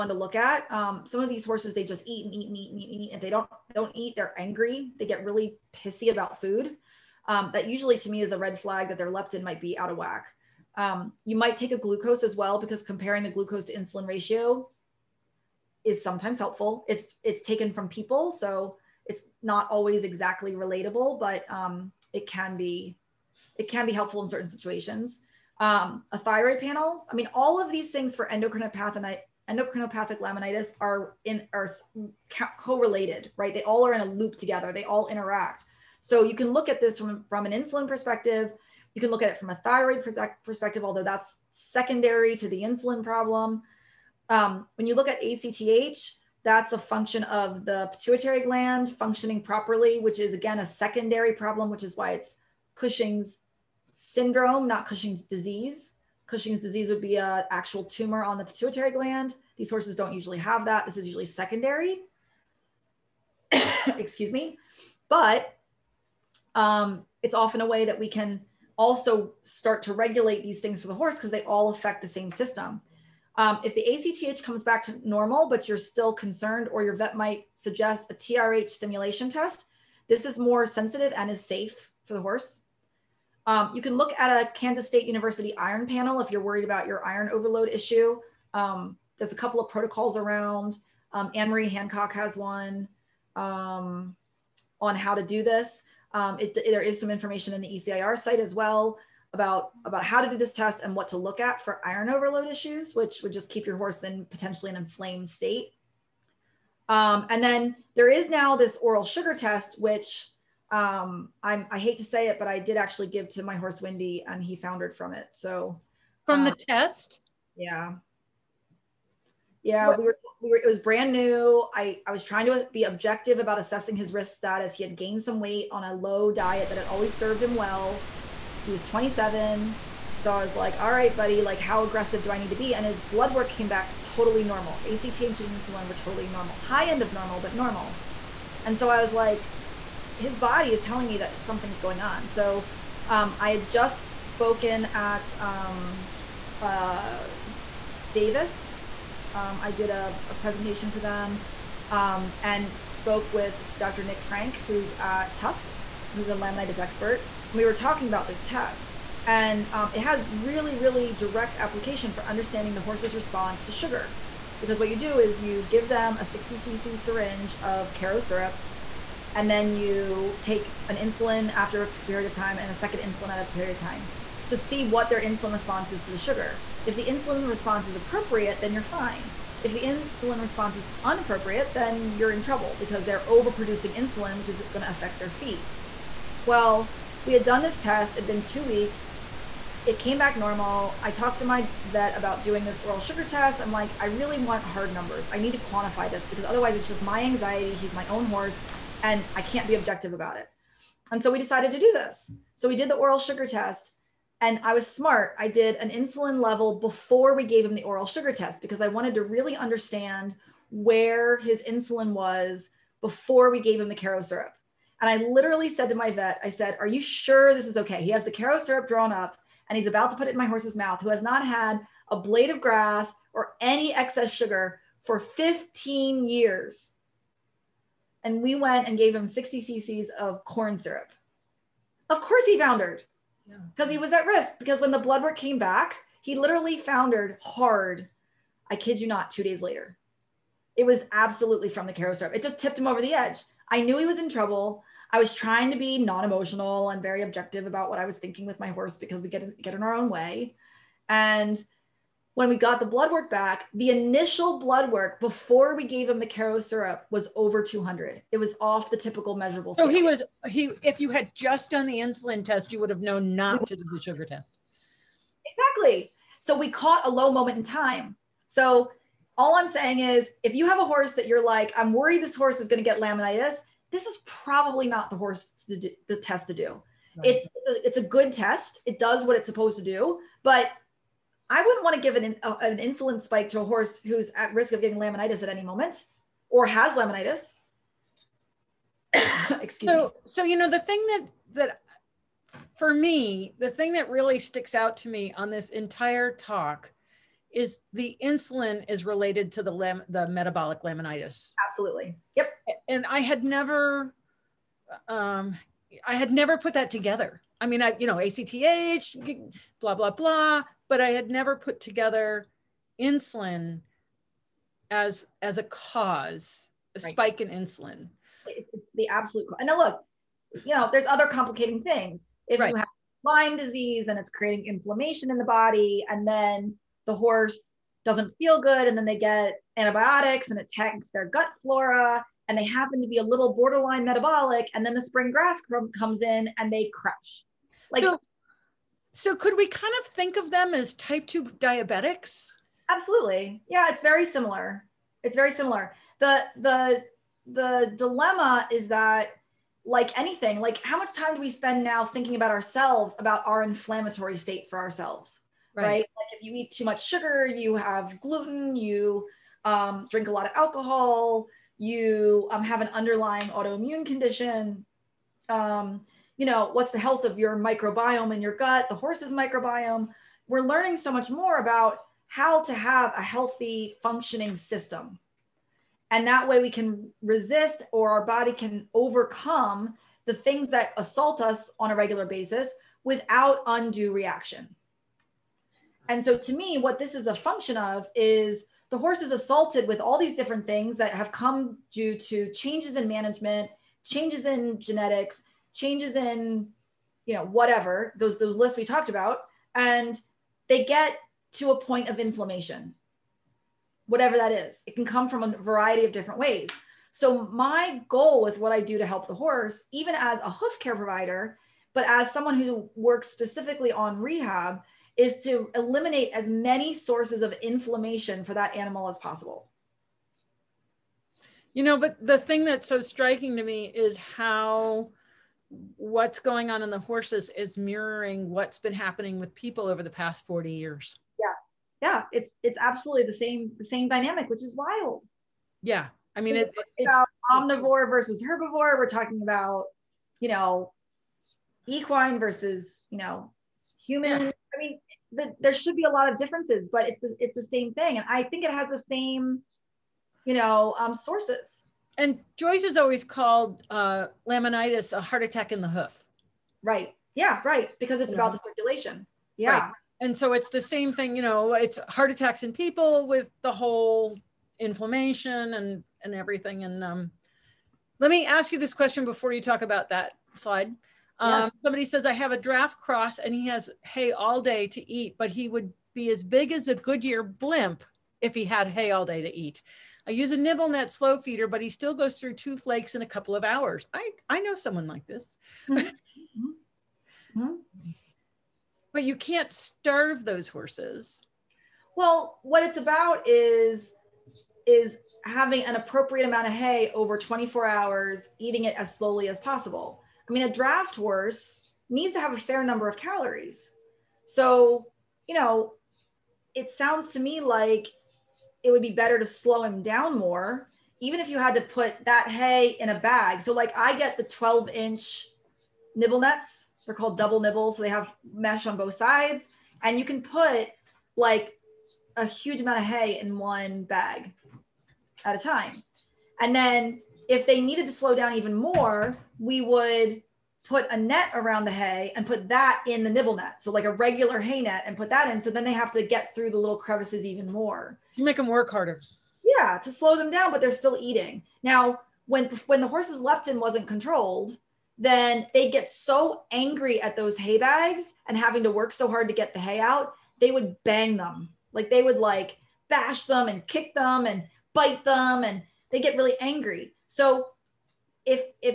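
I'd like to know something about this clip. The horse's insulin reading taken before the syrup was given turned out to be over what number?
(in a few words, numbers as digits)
200.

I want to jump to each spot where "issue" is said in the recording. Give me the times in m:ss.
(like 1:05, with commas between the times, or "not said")
1:27, 1:42.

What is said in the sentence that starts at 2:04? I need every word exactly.
He had gained some weight on a low diet that had always served him well.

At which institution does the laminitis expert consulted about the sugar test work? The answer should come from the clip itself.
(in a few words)
Tufts.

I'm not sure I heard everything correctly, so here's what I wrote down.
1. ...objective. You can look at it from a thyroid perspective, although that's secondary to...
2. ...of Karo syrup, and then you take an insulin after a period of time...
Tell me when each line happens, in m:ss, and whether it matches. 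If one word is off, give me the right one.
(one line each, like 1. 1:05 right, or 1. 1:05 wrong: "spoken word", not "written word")
1. 0:37 wrong: "perspective", not "objective"
2. 2:47 right.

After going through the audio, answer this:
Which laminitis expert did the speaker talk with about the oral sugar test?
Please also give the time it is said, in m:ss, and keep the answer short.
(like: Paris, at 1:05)
Dr. Nick Frank, at 2:33.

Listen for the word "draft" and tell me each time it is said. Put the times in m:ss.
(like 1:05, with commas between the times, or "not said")
7:52, 8:20.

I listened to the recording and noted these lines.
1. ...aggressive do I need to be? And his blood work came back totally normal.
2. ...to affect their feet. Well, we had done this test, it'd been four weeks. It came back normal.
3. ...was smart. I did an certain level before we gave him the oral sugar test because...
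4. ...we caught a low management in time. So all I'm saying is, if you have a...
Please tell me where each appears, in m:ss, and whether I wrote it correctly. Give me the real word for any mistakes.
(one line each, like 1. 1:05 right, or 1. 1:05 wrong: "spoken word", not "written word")
1. 2:11 right
2. 3:04 wrong: "two", not "four"
3. 3:24 wrong: "insulin", not "certain"
4. 4:26 wrong: "moment", not "management".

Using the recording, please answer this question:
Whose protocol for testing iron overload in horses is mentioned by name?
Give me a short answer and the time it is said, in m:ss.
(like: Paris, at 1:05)
Anne-Marie Hancock, at 1:31.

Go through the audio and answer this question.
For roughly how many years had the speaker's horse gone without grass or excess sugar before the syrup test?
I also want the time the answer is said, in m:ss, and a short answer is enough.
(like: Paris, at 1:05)
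15, at 3:45.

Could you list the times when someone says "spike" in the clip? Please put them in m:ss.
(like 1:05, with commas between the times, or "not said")
4:43, 5:17.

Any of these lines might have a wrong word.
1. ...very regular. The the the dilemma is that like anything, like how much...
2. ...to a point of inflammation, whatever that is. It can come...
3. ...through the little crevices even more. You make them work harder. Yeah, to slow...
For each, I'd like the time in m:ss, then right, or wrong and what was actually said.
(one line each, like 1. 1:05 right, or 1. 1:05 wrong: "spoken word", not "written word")
1. 5:45 wrong: "similar", not "regular"
2. 6:41 right
3. 8:56 right.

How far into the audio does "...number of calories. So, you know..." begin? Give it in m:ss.
8:22.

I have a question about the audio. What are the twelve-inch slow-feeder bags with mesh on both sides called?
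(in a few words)
double nibbles.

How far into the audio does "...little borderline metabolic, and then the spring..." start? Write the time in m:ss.
5:33.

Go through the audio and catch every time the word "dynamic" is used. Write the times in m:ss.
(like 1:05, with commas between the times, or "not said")
7:14.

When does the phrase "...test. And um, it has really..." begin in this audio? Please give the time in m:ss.
2:38.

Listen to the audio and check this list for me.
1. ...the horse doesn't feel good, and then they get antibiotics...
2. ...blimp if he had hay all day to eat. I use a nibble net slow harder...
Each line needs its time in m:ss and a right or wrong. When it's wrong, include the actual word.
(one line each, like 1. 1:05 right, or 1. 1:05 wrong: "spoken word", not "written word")
1. 5:27 right
2. 7:57 wrong: "feeder", not "harder".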